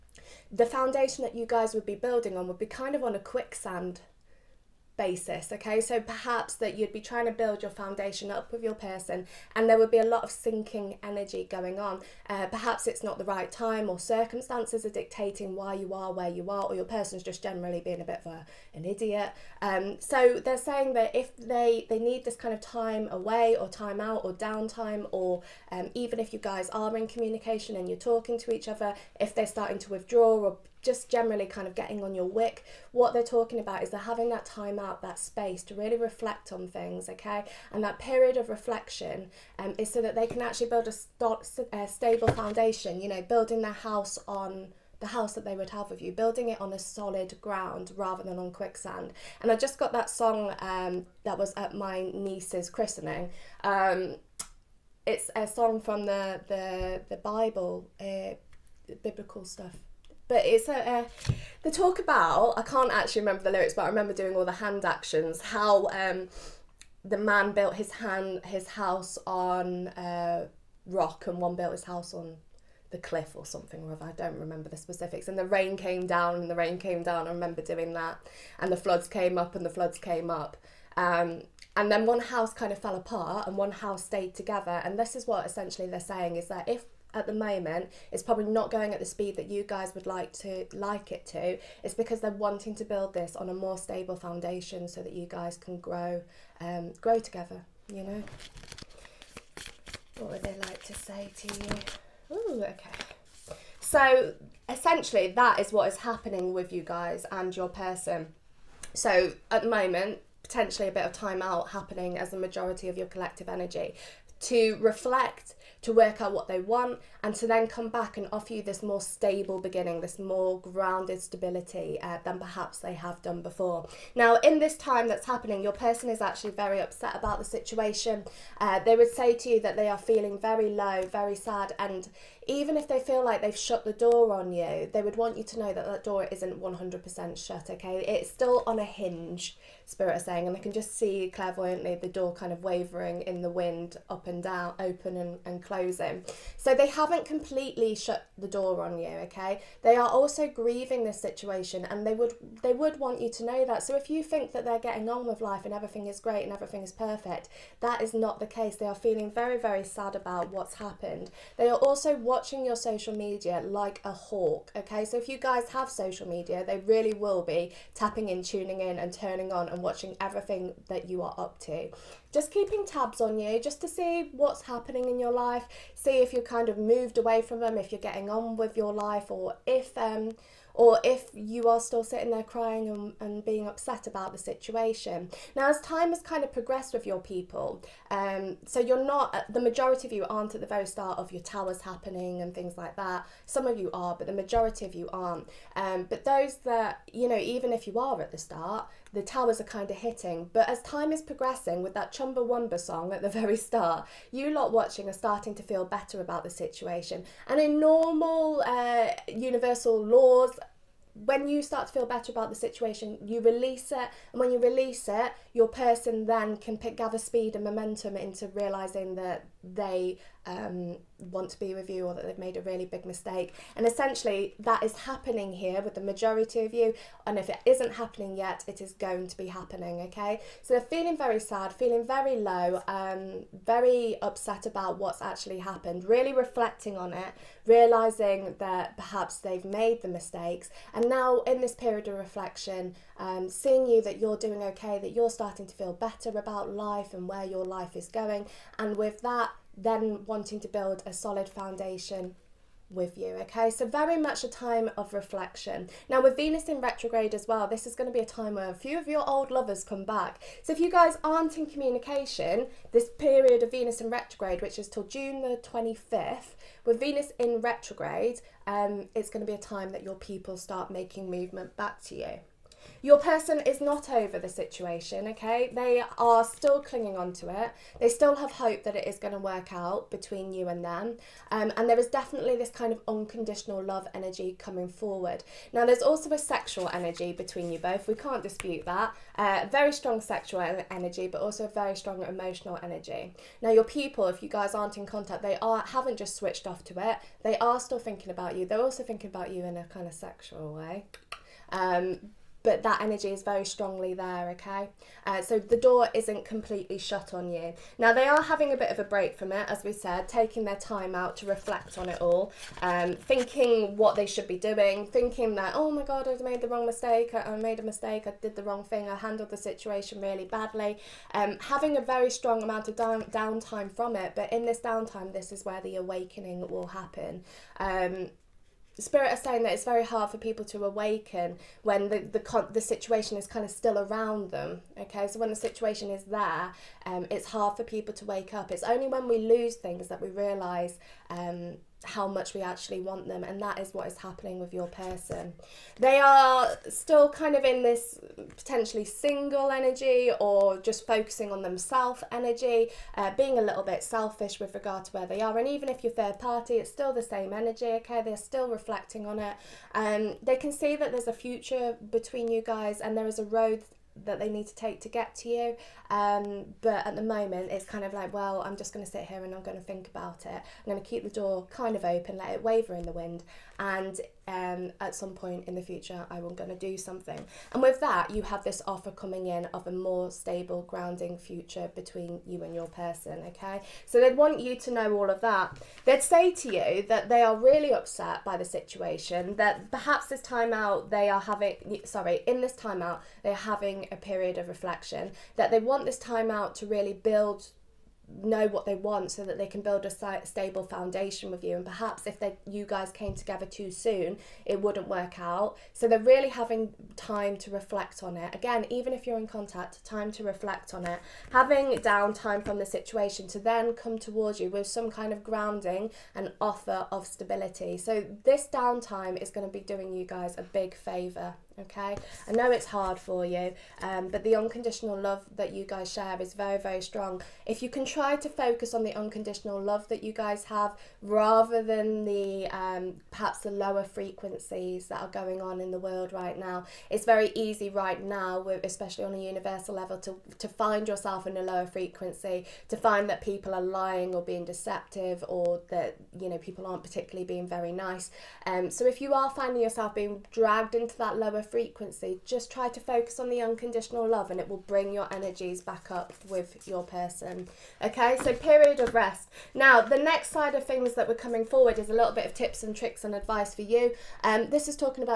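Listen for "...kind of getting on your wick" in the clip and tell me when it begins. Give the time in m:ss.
0:31.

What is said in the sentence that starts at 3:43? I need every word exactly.
And essentially, that is happening here with the majority of you.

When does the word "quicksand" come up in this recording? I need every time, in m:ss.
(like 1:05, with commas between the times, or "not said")
0:03, 0:48.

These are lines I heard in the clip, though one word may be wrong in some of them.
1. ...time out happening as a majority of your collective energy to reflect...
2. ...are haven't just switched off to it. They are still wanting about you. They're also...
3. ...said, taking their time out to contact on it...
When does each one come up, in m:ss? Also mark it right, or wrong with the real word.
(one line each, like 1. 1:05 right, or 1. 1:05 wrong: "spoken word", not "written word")
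1. 1:51 right
2. 4:55 wrong: "thinking", not "wanting"
3. 5:09 wrong: "reflect", not "contact".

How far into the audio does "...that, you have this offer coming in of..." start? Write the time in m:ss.
6:17.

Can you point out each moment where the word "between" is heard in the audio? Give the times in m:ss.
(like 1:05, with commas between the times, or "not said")
4:40, 4:47, 6:02, 6:21.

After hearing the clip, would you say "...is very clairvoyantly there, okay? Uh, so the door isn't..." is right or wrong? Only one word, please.
wrong.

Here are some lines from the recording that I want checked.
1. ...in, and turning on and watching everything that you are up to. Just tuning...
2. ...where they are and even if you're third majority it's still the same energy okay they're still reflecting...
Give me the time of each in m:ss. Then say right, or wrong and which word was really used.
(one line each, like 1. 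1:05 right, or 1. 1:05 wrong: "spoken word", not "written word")
1. 2:48 wrong: "keeping", not "tuning"
2. 5:55 wrong: "party", not "majority".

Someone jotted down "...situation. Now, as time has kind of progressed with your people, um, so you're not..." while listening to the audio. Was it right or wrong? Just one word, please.
right.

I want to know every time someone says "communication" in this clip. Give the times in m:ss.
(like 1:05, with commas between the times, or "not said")
0:27, 4:21.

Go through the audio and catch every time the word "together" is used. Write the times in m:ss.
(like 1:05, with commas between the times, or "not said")
1:24, 1:37, 6:43.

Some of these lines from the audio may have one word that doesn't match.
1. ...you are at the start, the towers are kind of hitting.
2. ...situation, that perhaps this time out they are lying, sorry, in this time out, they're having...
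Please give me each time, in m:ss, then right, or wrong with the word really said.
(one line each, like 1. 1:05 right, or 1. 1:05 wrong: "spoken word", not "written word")
1. 3:17 right
2. 6:28 wrong: "having", not "lying".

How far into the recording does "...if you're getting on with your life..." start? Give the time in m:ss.
2:57.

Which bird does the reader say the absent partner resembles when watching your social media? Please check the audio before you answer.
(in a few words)
hawk.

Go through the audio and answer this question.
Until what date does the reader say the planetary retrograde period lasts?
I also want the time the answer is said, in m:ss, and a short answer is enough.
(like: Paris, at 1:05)
June 25, at 4:25.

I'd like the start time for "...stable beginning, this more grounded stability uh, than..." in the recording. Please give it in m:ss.
1:58.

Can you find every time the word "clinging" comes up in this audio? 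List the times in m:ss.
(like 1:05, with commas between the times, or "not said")
4:36.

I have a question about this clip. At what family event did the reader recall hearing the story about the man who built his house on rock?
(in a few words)
niece's christening.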